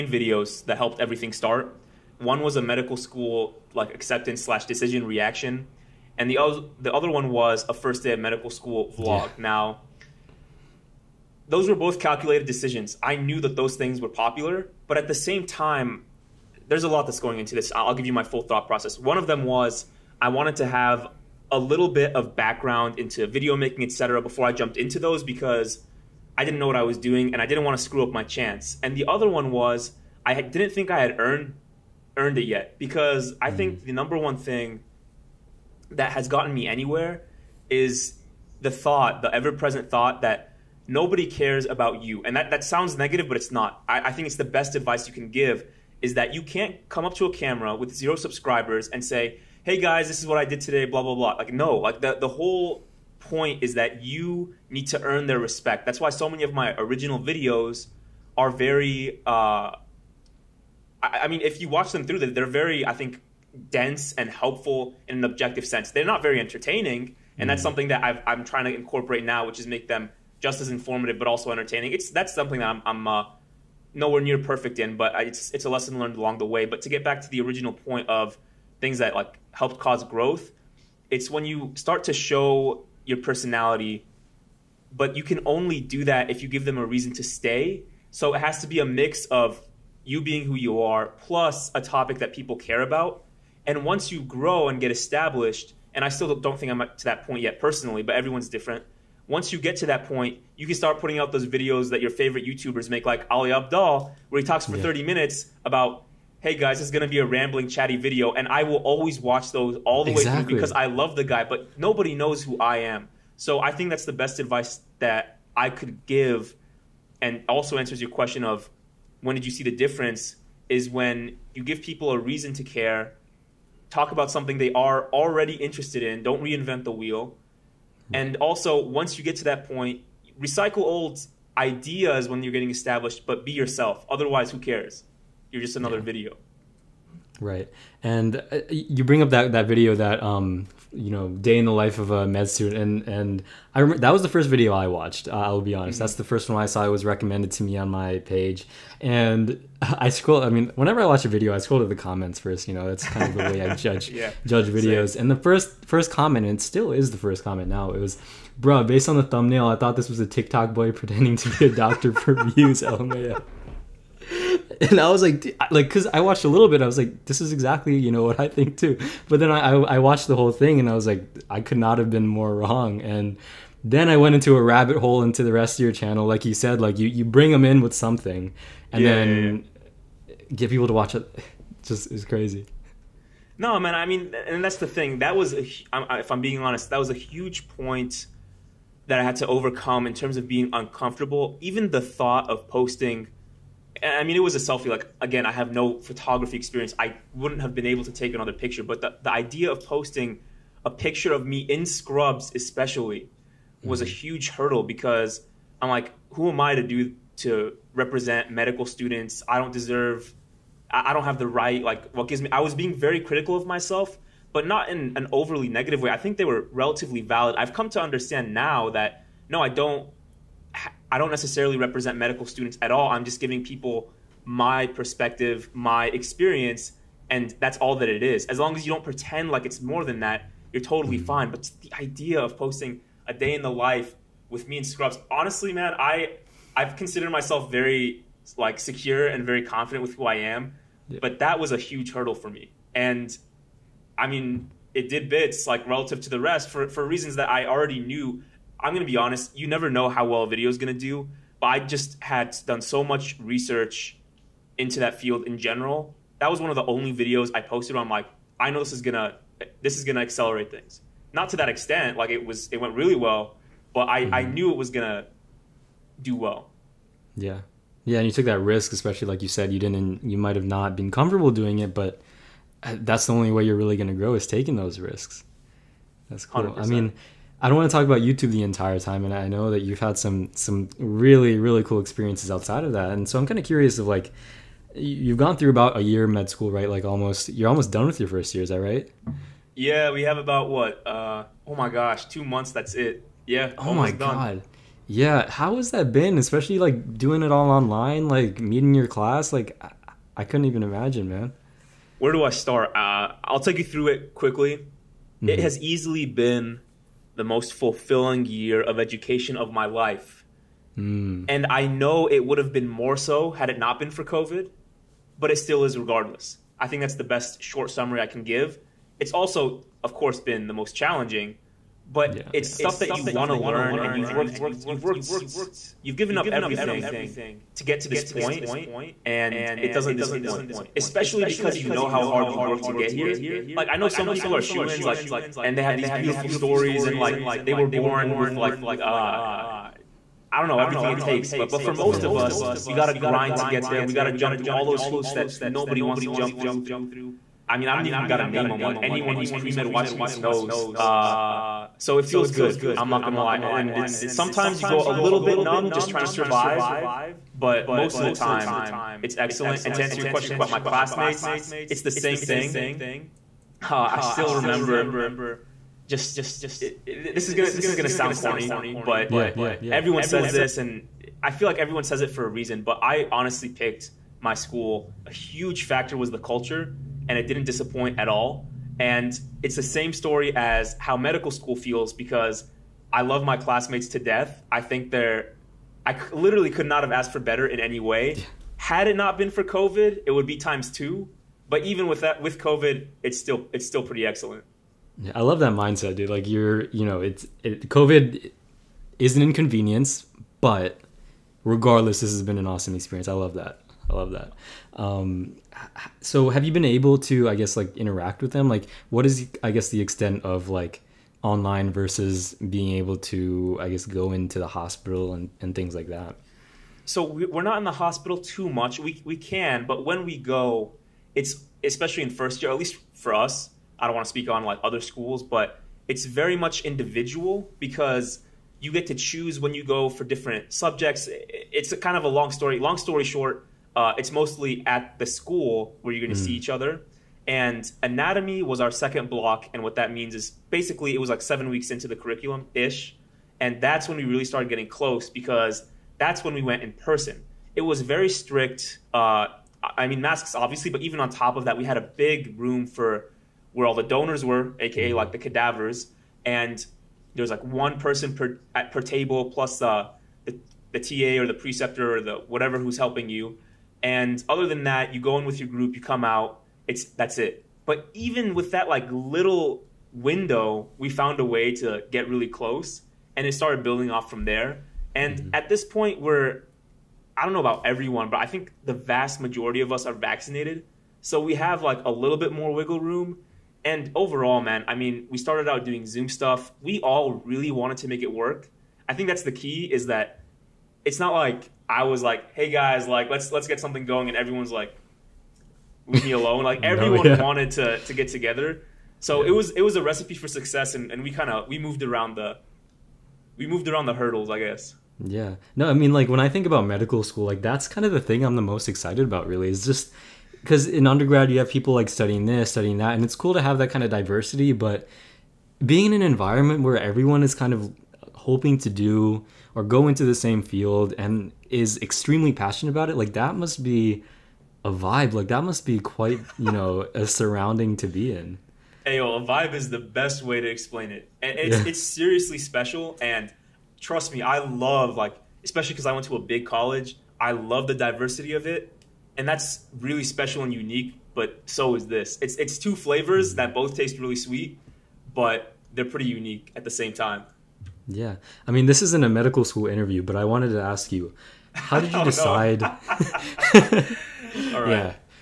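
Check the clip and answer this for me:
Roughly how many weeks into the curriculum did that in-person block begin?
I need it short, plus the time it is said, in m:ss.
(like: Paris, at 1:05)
7 weeks, at 7:21.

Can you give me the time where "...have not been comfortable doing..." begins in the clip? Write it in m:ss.
4:30.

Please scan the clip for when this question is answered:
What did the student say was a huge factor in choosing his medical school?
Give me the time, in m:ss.
6:16.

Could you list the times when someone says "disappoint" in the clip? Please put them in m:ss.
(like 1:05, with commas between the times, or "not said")
5:30, 6:17.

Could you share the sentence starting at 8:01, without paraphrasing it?
So we have like a little bit more wiggle room and overall, man, I mean, we started out doing Zoom stuff.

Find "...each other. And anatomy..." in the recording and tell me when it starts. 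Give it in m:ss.
7:16.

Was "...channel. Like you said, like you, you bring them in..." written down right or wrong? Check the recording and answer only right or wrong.
right.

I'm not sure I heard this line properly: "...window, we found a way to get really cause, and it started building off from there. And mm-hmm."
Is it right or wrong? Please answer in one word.
wrong.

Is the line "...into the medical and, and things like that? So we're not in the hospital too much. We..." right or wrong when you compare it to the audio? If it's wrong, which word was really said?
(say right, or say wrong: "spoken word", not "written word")
wrong: "hospital", not "medical".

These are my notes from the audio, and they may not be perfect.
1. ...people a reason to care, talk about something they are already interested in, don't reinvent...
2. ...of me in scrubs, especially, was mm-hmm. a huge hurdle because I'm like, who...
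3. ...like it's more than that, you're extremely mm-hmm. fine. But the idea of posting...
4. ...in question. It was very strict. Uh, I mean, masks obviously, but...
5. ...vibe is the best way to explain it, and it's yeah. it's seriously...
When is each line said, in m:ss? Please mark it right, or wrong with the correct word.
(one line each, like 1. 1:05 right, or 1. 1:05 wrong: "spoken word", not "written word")
1. 2:01 right
2. 3:21 right
3. 3:49 wrong: "totally", not "extremely"
4. 7:26 wrong: "person", not "question"
5. 8:49 right.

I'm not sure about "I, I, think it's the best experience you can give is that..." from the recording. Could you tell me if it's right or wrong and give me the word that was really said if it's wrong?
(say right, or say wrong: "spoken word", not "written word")
wrong: "advice", not "experience".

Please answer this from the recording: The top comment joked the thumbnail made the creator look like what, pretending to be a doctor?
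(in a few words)
A TikTok boy.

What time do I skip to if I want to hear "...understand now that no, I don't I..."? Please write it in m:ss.
3:38.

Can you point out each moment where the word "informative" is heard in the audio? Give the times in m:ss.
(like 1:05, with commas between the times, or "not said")
1:10.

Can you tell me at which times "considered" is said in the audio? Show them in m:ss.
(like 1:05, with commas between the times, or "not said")
3:56.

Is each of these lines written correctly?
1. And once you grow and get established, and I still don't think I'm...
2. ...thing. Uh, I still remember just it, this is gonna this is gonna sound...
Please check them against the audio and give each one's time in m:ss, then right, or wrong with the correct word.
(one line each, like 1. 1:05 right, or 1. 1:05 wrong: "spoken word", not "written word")
1. 1:33 right
2. 6:02 right.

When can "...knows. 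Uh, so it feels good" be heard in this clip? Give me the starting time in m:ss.
5:50.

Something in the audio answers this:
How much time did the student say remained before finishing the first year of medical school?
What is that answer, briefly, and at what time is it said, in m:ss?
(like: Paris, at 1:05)
2 months, at 4:52.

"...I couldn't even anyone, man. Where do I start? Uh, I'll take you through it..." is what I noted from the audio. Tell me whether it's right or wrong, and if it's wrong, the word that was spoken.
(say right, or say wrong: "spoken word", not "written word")
wrong: "imagine", not "anyone".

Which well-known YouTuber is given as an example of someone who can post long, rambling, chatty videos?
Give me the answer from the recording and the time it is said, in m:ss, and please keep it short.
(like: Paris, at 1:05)
Ali Abdaal, at 1:43.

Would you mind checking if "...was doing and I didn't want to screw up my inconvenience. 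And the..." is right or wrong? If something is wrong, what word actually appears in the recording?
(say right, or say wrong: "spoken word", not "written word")
wrong: "chance", not "inconvenience".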